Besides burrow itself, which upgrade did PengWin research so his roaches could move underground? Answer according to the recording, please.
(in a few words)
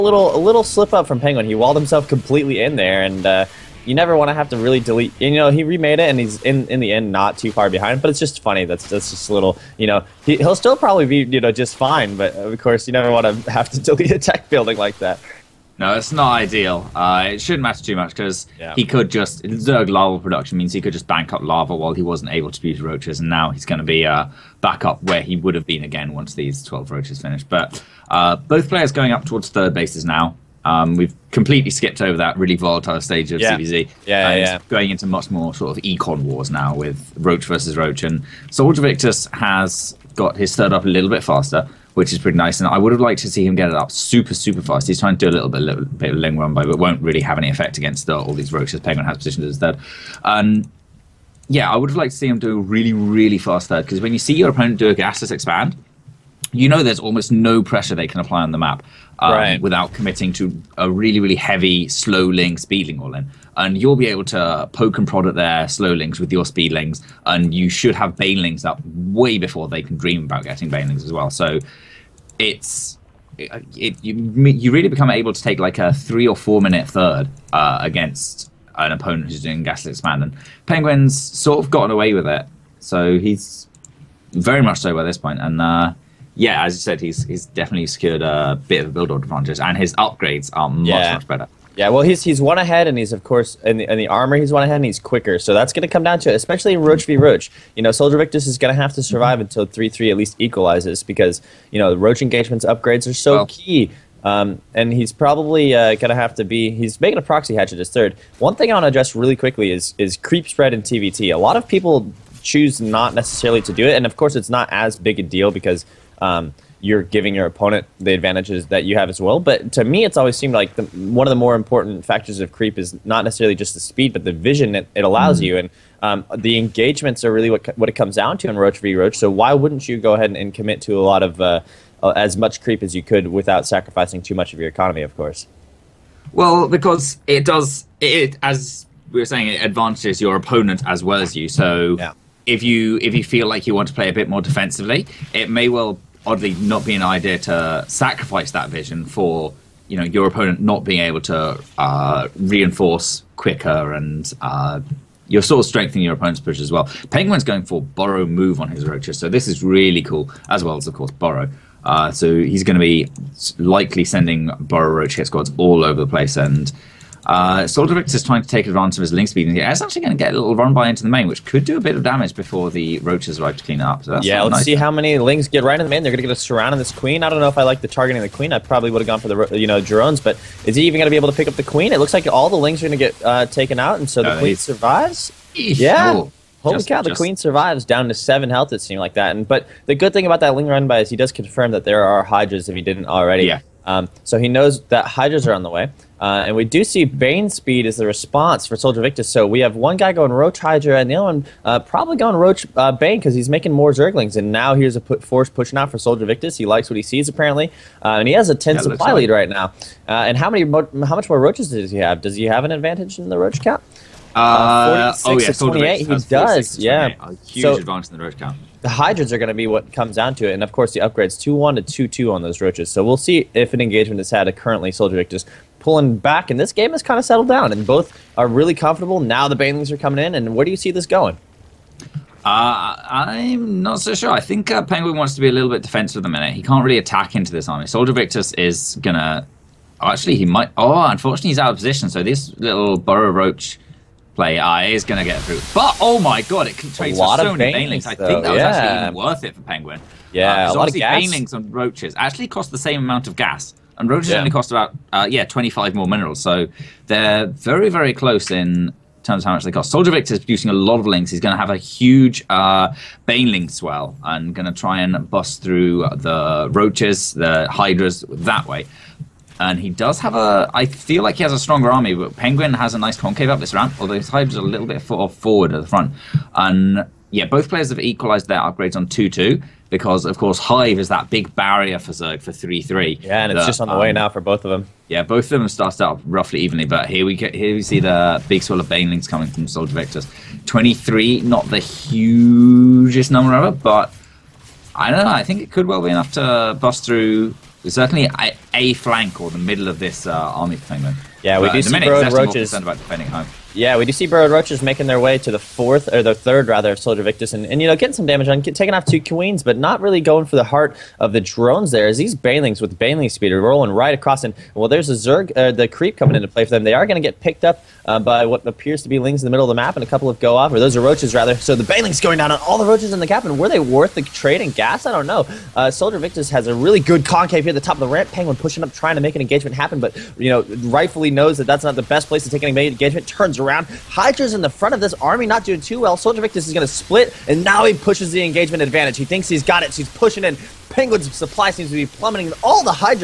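burrow move.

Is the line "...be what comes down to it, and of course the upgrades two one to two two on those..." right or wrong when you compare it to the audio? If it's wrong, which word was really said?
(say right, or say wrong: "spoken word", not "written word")
right.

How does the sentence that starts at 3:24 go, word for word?
And now here's a put force pushing out for SoLJerVictus.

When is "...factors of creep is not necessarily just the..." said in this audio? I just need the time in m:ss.
2:02.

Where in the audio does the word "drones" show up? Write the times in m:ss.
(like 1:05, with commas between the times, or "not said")
2:59, 5:11.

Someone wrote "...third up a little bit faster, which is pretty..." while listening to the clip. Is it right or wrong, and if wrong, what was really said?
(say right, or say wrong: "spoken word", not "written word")
right.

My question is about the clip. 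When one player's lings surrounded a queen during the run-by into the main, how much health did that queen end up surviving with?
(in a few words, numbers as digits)
7.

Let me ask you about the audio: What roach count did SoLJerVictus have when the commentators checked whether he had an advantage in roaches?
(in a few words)
28.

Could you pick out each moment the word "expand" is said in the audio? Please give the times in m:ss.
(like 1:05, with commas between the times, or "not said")
0:55, 1:19.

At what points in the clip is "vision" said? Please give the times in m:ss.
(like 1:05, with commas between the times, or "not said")
2:04, 2:28.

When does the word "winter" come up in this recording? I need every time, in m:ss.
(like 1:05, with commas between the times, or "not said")
not said.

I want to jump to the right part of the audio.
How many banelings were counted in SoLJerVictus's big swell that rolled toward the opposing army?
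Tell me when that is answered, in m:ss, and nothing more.
4:50.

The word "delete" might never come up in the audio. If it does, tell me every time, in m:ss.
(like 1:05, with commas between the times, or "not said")
0:04, 0:13.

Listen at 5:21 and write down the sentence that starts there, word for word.
So the banelings going down on all the roaches in the cap, and were they worth the trade and gas?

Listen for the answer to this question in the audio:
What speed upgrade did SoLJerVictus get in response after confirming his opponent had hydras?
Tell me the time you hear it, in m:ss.
3:17.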